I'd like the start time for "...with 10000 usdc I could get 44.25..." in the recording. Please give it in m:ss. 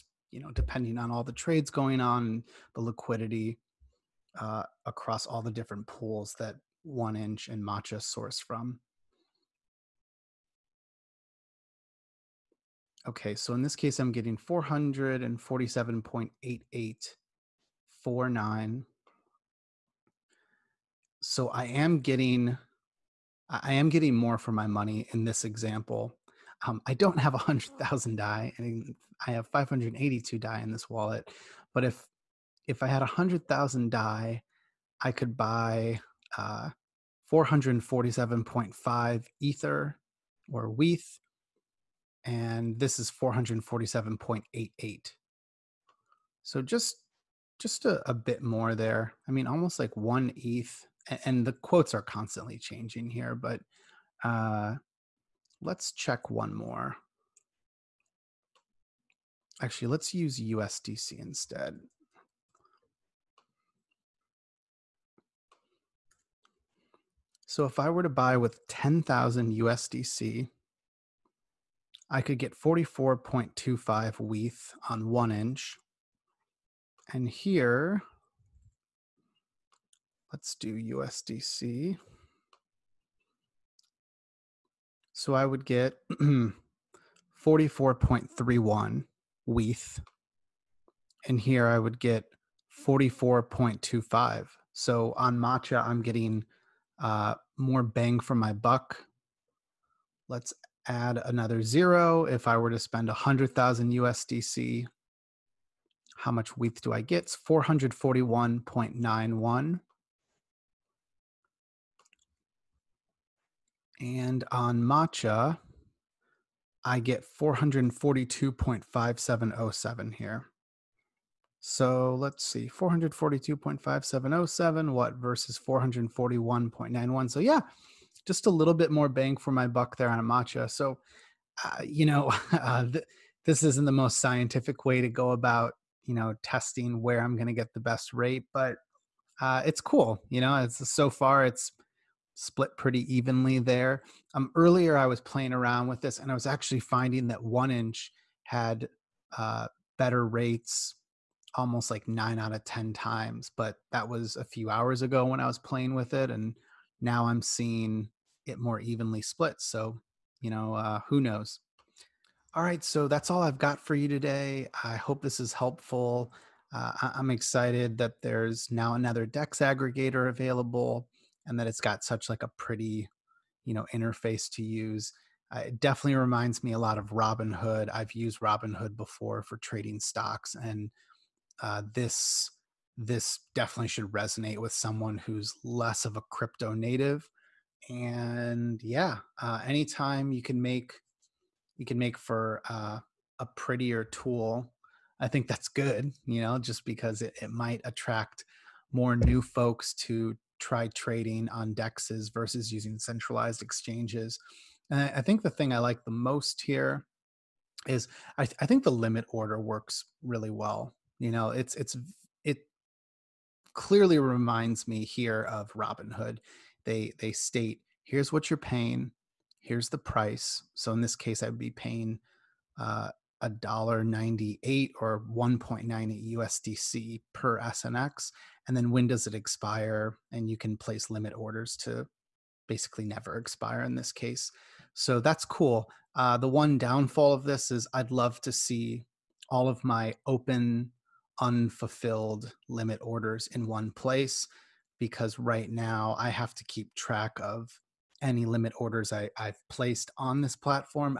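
1:08.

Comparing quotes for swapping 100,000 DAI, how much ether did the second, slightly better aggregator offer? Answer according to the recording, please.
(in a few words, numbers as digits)
447.8849.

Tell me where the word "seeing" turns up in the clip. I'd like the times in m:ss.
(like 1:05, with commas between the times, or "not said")
2:37.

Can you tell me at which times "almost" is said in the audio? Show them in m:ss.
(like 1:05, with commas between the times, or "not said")
0:49, 2:31.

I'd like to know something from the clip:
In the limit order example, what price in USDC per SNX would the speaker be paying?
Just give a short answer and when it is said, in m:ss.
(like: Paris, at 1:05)
1.98, at 3:45.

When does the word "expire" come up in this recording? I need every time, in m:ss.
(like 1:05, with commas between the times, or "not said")
3:49, 3:53.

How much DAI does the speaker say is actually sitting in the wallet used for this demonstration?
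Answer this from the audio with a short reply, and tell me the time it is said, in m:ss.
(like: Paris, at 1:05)
582, at 0:29.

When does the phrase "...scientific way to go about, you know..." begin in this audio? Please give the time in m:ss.
2:14.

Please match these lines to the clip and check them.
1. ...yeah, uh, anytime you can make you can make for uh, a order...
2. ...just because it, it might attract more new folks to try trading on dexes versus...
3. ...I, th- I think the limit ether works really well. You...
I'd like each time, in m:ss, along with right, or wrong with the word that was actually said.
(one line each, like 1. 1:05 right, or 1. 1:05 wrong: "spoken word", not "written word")
1. 3:08 wrong: "prettier", not "order"
2. 3:16 right
3. 3:28 wrong: "order", not "ether".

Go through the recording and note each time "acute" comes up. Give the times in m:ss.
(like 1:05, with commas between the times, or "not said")
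not said.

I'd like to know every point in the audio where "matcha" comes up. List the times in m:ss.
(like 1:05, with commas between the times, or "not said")
0:07, 1:35, 2:10.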